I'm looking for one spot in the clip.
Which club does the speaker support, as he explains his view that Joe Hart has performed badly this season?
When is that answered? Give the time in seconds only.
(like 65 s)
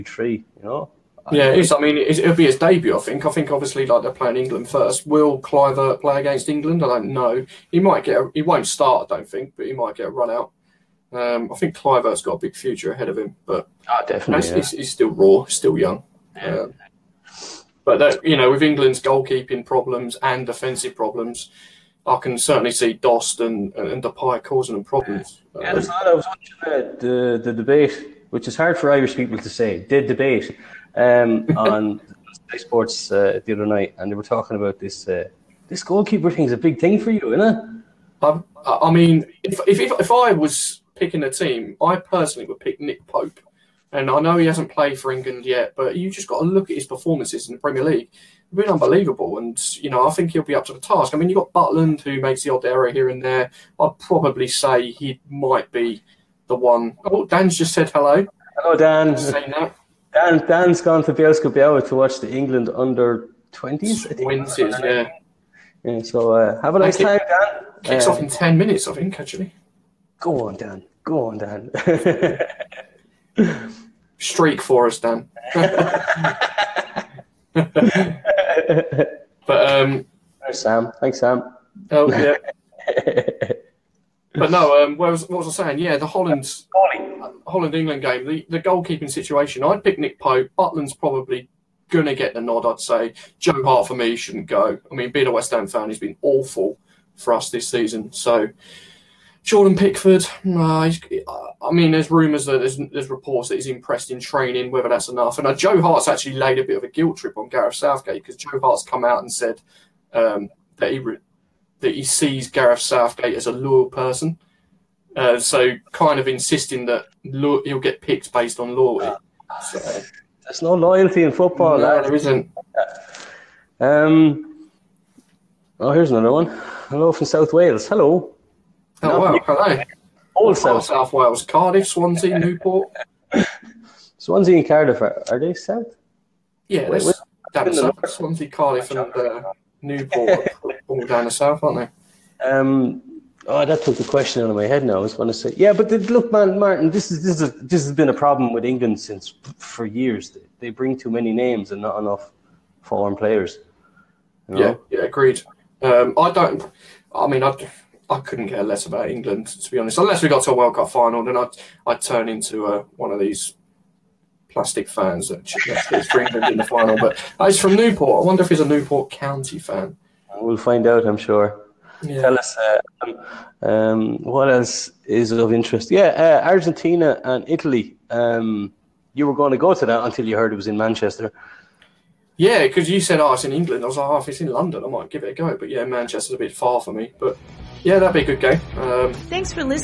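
95 s.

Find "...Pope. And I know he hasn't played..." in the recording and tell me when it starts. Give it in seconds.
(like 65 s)
43 s.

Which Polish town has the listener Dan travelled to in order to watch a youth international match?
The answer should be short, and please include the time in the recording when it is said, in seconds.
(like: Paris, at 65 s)
Bielsko Biała, at 61 s.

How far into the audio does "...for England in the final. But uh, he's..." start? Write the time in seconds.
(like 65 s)
166 s.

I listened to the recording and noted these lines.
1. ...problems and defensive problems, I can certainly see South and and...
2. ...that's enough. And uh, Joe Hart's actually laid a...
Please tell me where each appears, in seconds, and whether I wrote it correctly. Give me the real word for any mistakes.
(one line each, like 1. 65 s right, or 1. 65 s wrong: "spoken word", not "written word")
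1. 19 s wrong: "Dost", not "South"
2. 104 s right.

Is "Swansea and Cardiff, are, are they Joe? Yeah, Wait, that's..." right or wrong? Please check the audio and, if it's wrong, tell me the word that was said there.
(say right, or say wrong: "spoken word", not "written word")
wrong: "South", not "Joe".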